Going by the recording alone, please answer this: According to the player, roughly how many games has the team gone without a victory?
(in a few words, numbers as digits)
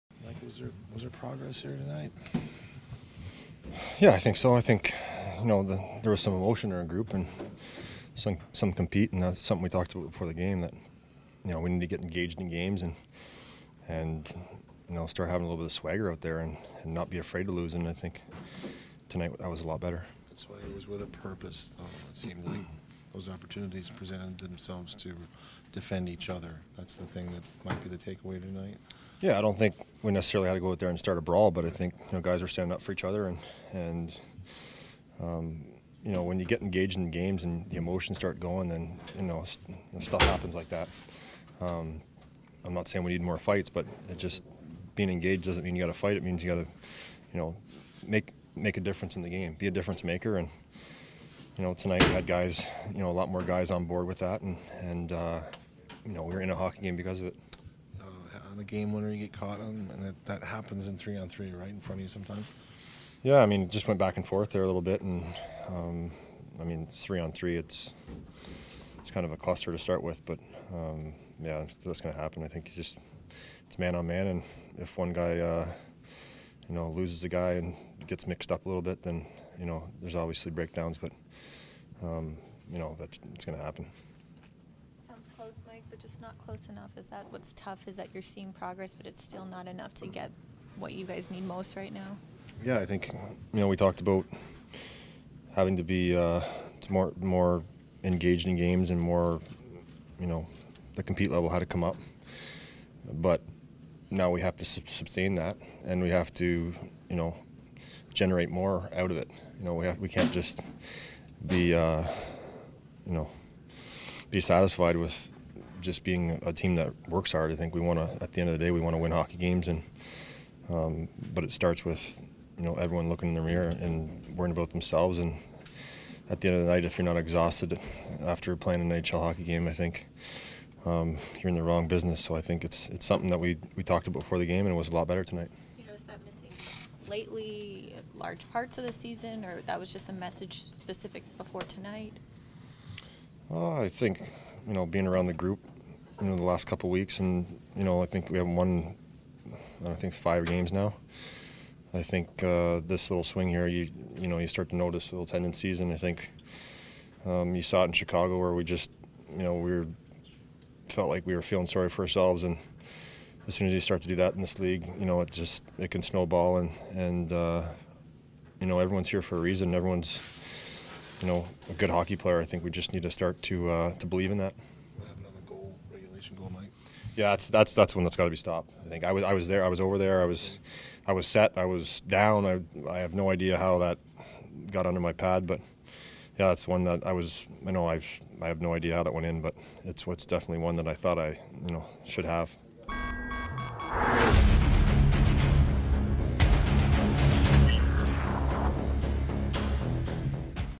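5.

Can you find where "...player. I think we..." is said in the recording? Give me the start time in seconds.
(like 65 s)
172 s.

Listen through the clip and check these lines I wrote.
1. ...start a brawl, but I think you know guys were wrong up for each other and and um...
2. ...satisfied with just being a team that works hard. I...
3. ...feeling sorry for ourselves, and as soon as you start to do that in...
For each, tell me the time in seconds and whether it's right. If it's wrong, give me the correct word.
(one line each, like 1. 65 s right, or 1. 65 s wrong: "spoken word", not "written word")
1. 30 s wrong: "standing", not "wrong"
2. 114 s right
3. 161 s right.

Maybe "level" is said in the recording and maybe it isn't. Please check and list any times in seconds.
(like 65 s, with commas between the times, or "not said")
101 s.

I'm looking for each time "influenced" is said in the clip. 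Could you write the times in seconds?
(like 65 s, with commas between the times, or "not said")
not said.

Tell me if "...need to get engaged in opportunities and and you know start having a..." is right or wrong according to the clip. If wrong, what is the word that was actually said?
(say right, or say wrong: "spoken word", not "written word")
wrong: "games", not "opportunities".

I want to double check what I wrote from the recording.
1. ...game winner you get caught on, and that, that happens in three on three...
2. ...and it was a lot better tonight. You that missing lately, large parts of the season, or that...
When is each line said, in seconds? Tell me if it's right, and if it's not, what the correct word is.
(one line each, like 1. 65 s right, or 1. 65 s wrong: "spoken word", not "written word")
1. 58 s right
2. 134 s right.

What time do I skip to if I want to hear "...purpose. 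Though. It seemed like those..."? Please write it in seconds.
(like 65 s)
21 s.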